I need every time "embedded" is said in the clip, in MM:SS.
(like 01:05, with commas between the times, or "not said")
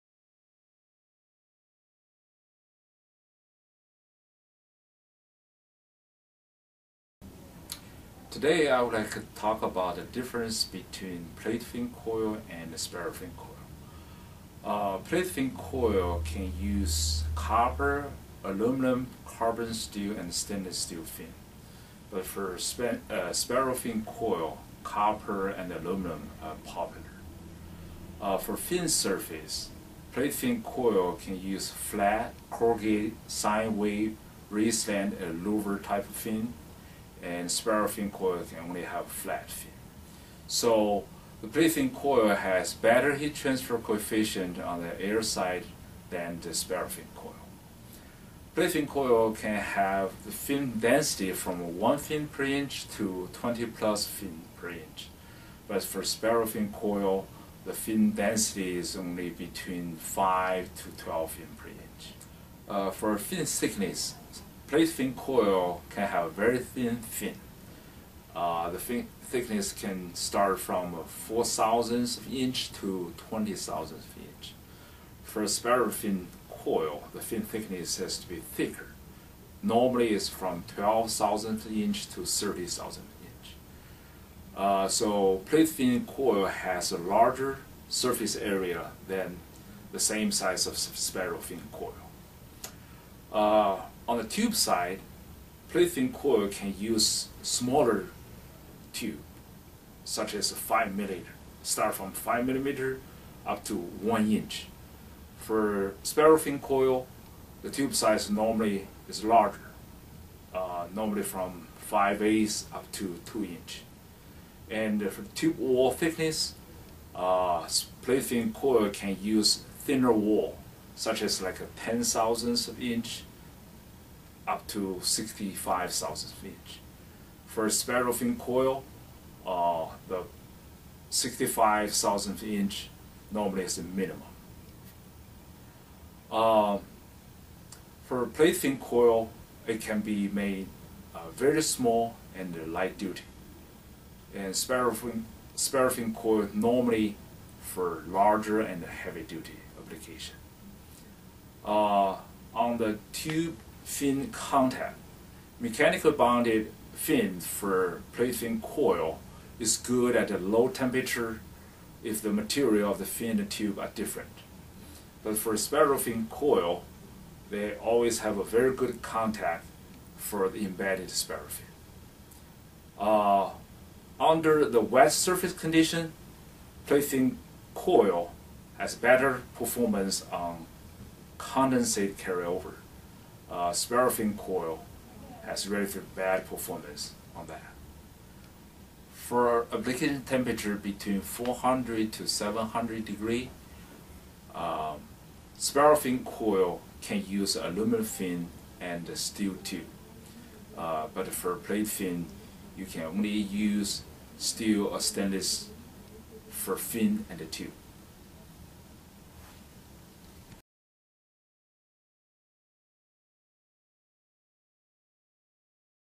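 02:50.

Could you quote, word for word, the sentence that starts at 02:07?
For fin coil, uh, the 65,000 inch normally is the minimum.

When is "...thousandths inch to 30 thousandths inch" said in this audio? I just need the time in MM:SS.
01:21.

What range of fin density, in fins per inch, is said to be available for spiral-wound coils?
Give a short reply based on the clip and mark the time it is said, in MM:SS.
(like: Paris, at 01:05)
5 to 12, at 00:59.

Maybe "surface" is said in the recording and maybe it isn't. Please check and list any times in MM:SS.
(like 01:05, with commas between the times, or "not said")
00:28, 01:27, 02:55.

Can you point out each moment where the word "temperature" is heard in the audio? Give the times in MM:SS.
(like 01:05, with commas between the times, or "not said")
02:40, 03:10.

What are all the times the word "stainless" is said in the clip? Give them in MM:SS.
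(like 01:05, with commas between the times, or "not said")
00:20, 03:24.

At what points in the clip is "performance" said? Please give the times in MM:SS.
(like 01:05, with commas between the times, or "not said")
02:59, 03:06.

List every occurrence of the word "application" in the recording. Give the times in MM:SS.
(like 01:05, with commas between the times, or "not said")
02:29, 03:09.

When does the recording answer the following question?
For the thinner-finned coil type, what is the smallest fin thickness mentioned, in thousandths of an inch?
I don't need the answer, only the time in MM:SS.
01:11.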